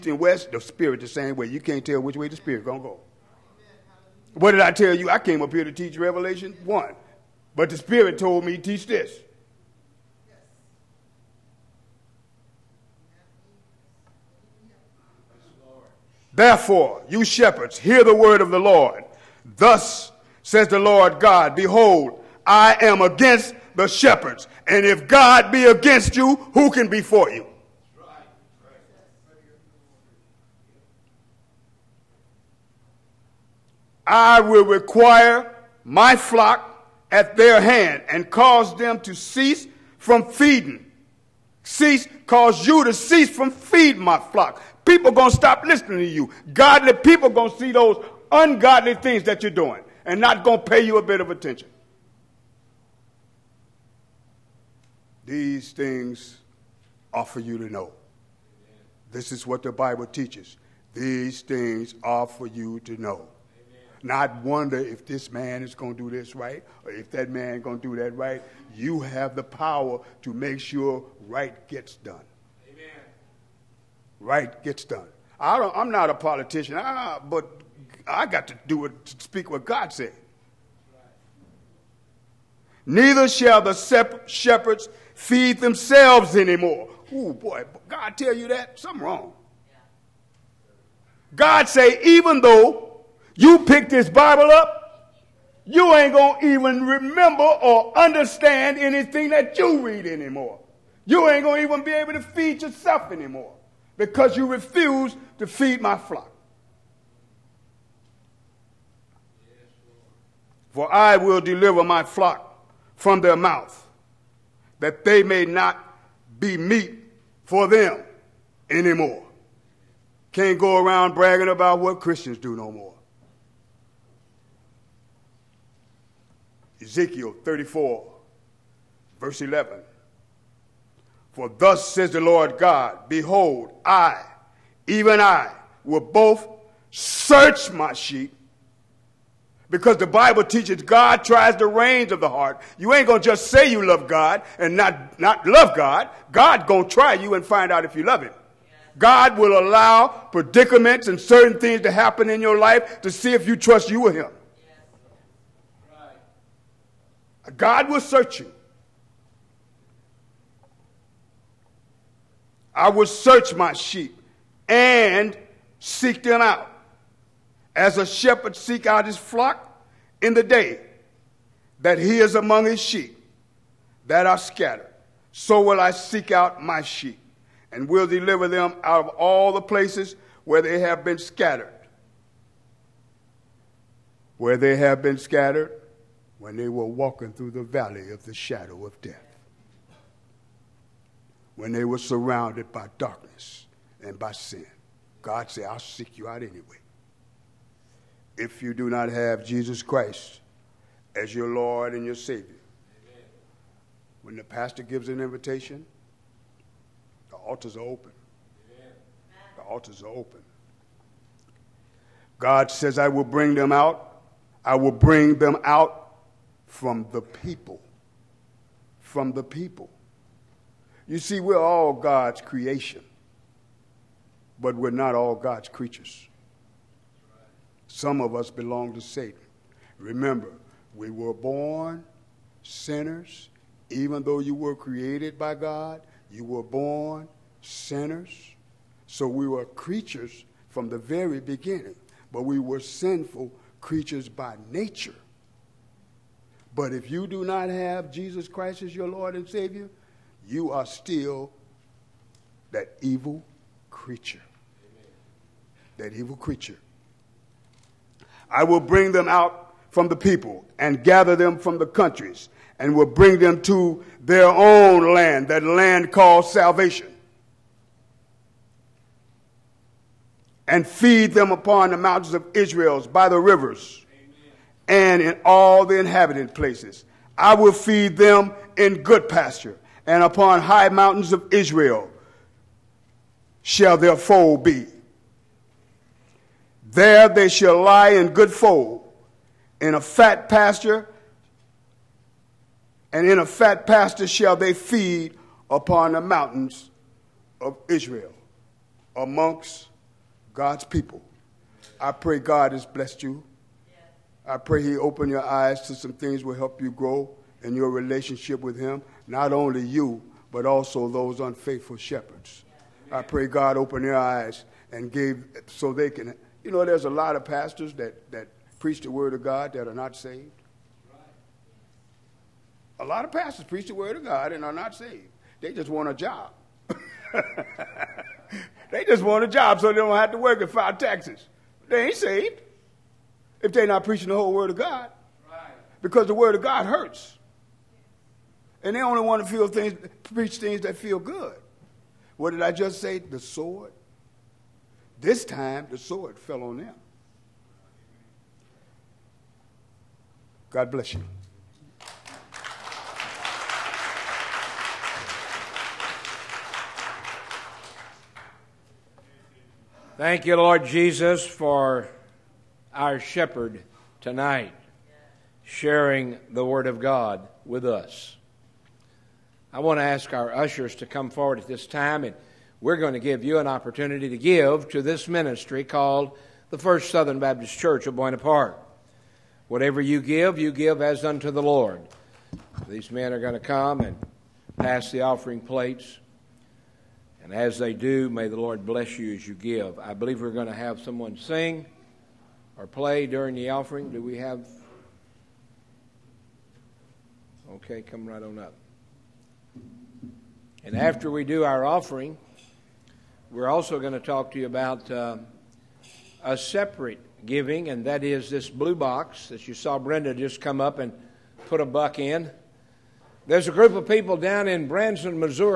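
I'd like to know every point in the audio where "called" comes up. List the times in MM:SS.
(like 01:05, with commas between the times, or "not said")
04:26, 06:15.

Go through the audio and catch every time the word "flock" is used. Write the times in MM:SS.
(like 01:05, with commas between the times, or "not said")
00:36, 00:44, 01:45, 01:52, 02:49.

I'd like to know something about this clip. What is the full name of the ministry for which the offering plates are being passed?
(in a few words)
First Southern Baptist Church of Buena Park.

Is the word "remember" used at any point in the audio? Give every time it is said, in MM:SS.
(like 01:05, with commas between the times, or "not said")
01:36, 03:49.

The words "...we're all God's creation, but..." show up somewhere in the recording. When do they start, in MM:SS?
03:41.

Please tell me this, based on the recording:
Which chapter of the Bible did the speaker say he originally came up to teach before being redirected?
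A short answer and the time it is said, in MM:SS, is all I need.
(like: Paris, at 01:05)
Revelation 1, at 00:05.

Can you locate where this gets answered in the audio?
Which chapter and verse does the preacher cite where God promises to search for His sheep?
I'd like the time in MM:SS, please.
02:06.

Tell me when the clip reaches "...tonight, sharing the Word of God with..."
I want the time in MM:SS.
06:04.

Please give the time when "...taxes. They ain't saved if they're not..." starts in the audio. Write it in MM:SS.
05:30.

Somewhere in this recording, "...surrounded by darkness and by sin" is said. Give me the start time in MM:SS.
03:11.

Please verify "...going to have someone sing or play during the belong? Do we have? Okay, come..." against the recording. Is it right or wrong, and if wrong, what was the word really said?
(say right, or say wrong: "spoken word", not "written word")
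wrong: "offering", not "belong".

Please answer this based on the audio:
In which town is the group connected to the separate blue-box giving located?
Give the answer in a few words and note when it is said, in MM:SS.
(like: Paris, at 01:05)
Branson, at 06:54.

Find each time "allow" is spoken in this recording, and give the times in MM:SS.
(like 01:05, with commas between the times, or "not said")
02:29.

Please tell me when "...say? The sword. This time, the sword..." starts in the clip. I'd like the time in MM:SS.
05:43.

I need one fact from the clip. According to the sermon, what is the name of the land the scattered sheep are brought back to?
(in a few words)
salvation.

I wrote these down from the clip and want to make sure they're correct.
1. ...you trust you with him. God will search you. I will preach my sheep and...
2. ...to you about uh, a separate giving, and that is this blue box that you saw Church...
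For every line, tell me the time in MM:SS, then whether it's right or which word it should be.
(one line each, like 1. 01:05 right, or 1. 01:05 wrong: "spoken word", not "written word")
1. 02:33 wrong: "search", not "preach"
2. 06:44 wrong: "Brenda", not "Church".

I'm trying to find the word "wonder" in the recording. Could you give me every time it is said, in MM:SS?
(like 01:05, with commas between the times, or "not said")
01:04.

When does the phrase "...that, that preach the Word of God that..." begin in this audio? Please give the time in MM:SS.
05:17.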